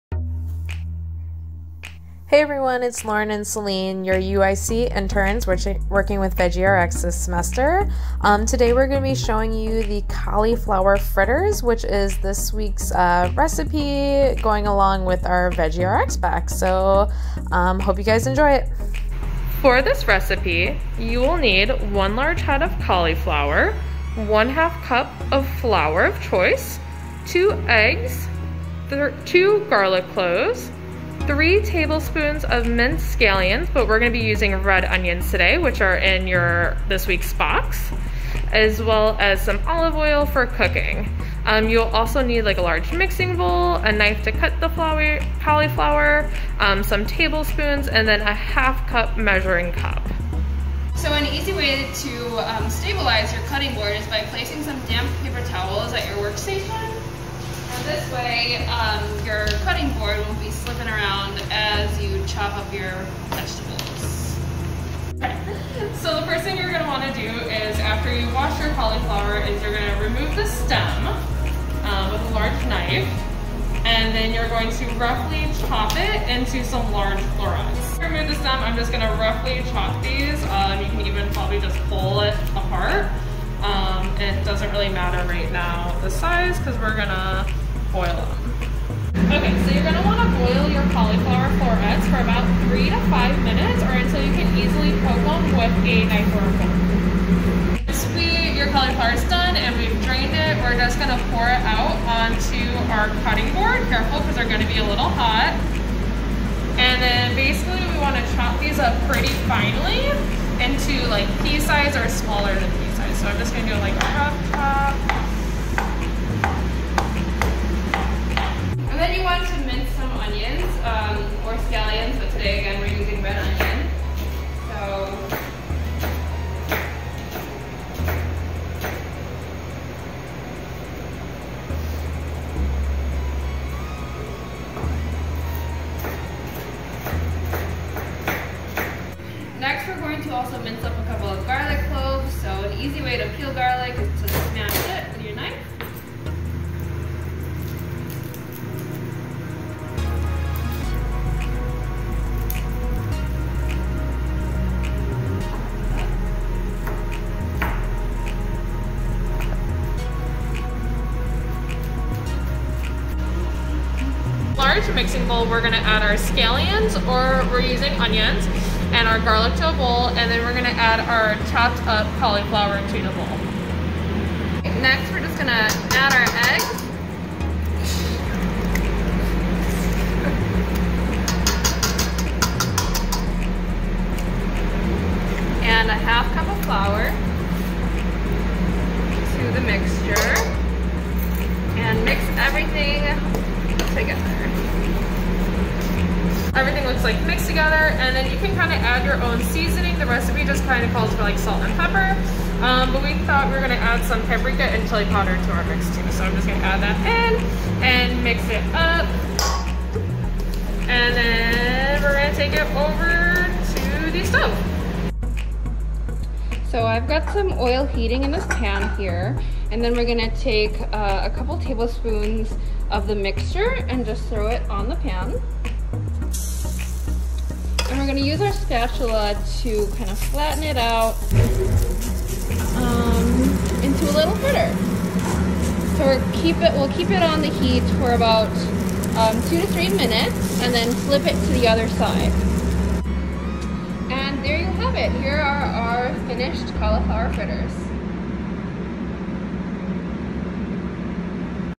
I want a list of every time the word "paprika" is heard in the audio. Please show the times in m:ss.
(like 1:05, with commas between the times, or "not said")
3:24.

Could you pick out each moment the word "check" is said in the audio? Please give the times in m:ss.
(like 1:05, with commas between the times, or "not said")
not said.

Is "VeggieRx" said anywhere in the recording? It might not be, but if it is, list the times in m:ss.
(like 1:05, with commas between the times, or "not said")
0:06, 0:15.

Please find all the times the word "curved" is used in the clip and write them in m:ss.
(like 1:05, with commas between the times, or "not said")
not said.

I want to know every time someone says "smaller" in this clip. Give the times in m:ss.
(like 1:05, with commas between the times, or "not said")
1:52.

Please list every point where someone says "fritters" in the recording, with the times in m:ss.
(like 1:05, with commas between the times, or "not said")
0:10, 3:54, 4:07.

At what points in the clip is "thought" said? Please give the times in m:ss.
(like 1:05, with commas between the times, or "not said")
3:23.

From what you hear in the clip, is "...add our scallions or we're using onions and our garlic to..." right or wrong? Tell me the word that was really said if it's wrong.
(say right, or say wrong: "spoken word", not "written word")
right.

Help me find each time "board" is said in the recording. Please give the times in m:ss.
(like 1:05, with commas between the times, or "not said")
0:53, 0:59, 1:43.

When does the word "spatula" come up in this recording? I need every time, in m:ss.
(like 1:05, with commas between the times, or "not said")
3:48.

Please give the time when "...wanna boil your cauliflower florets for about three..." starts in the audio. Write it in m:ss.
1:30.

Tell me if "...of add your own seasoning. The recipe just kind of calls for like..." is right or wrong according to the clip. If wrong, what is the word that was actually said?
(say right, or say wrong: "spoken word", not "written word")
right.